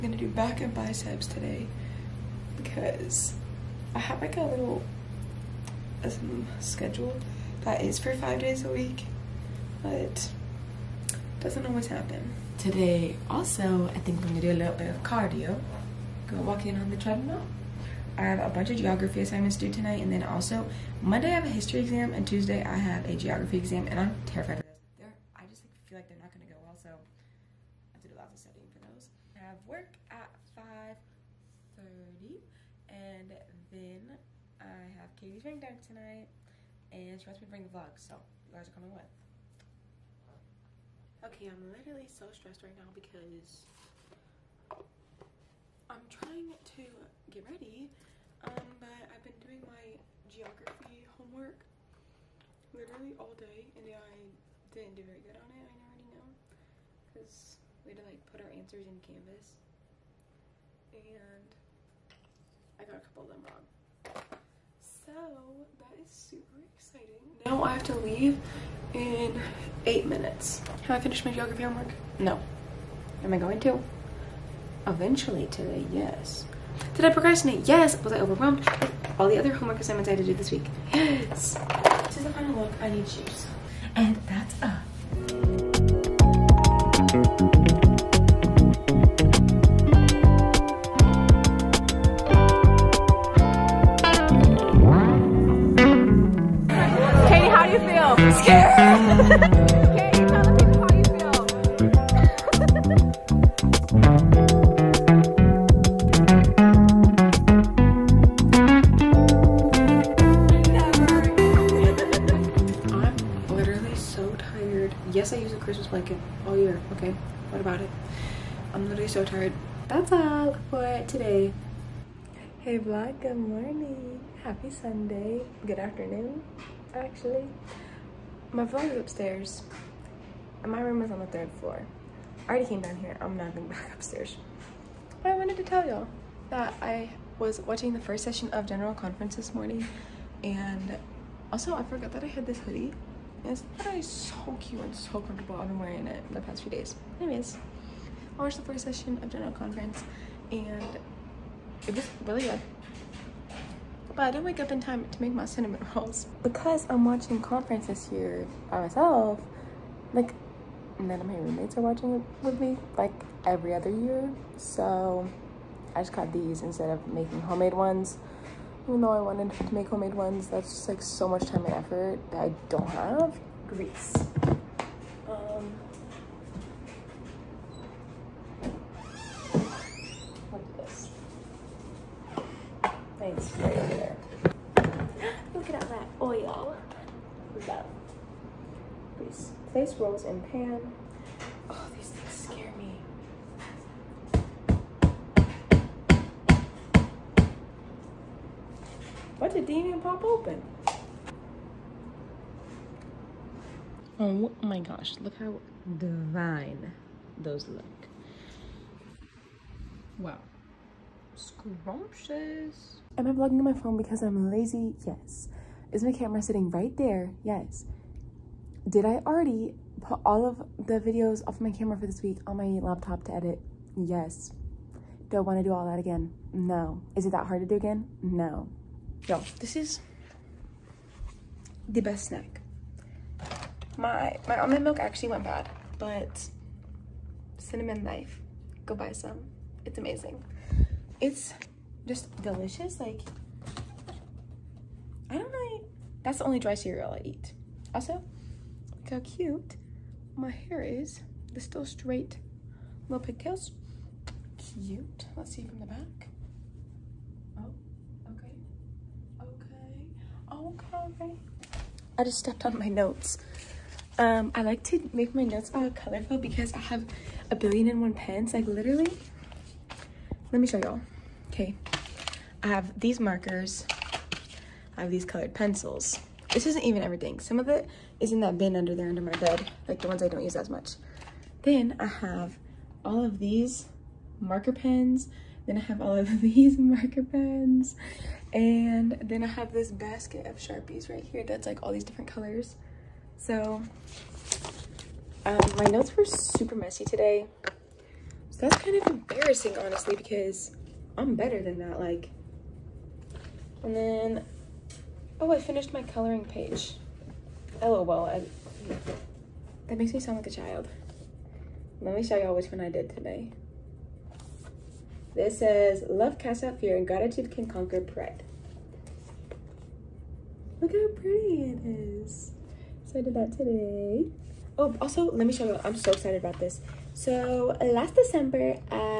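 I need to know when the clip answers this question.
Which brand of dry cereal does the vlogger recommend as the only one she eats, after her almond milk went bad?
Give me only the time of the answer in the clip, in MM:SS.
03:57.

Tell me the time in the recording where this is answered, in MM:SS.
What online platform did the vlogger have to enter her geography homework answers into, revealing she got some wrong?
00:59.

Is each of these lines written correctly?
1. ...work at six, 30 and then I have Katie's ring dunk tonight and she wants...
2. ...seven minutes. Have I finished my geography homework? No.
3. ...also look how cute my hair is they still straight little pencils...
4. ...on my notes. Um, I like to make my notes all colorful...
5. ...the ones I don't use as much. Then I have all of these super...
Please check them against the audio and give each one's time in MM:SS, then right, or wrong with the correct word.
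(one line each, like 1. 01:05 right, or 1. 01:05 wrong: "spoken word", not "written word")
1. 00:29 wrong: "five", not "six"
2. 01:09 wrong: "eight", not "seven"
3. 04:07 wrong: "pigtails", not "pencils"
4. 04:22 right
5. 04:40 wrong: "marker", not "super".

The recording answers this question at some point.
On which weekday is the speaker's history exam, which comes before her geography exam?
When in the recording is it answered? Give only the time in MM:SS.
00:21.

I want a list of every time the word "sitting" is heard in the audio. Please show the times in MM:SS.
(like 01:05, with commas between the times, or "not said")
03:36.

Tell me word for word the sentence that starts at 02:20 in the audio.
And also, I forgot that I had this hoodie but It's so cute and so comfortable.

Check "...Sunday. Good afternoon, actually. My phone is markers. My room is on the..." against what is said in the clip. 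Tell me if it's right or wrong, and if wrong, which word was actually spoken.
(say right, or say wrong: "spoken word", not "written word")
wrong: "upstairs", not "markers".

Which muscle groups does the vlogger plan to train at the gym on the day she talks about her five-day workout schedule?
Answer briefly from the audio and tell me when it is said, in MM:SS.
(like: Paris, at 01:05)
back and biceps, at 00:00.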